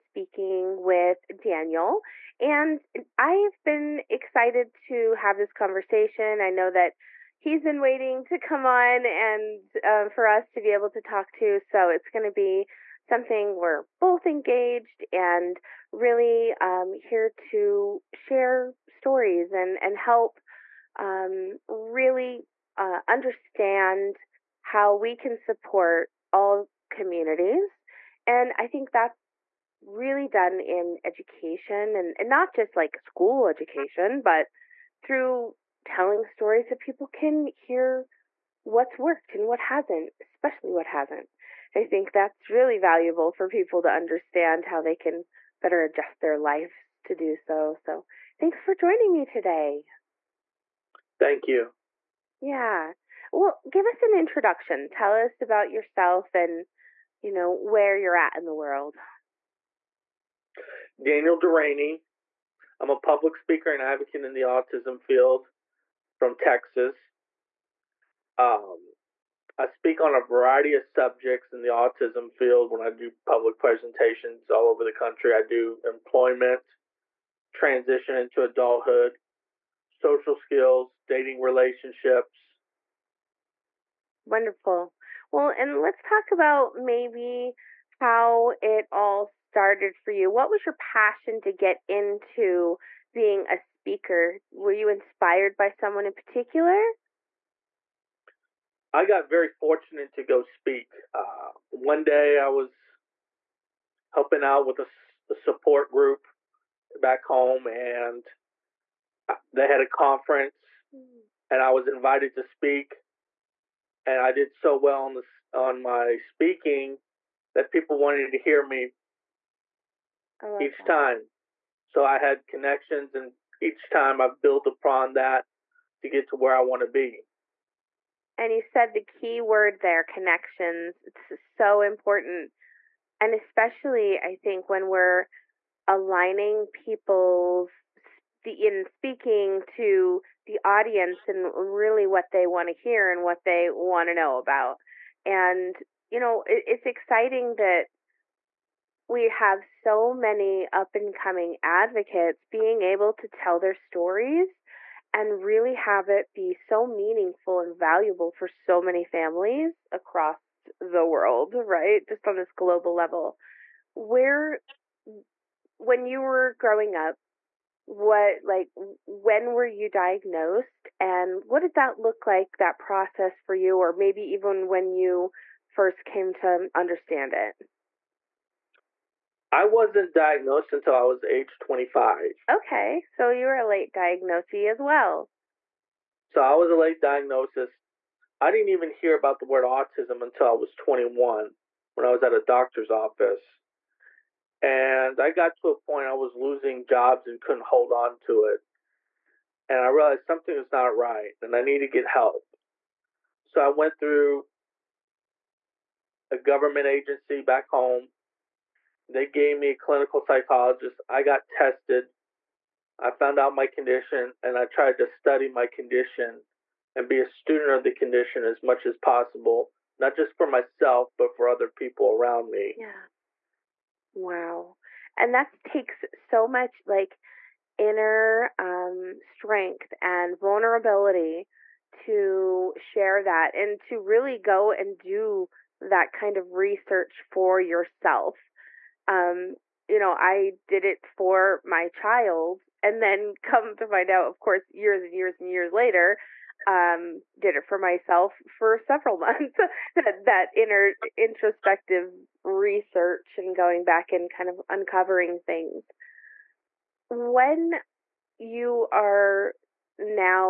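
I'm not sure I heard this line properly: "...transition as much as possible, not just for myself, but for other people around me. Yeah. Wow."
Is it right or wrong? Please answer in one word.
wrong.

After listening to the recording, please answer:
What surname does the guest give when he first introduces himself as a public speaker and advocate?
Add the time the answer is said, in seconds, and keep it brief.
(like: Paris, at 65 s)
Durany, at 61 s.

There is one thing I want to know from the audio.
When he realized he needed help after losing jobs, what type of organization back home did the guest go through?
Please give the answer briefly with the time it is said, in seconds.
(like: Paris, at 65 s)
Government agency, at 206 s.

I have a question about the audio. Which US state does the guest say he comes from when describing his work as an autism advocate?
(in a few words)
Texas.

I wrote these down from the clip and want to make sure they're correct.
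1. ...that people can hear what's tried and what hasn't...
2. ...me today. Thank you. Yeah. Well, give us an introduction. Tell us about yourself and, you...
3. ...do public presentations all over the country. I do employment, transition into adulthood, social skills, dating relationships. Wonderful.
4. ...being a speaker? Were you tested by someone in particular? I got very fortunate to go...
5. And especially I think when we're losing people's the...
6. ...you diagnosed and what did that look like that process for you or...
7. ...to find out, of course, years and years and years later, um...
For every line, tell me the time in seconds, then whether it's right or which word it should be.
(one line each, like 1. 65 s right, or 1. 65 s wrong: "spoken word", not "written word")
1. 36 s wrong: "worked", not "tried"
2. 49 s right
3. 72 s right
4. 93 s wrong: "inspired", not "tested"
5. 133 s wrong: "aligning", not "losing"
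6. 169 s right
7. 243 s right.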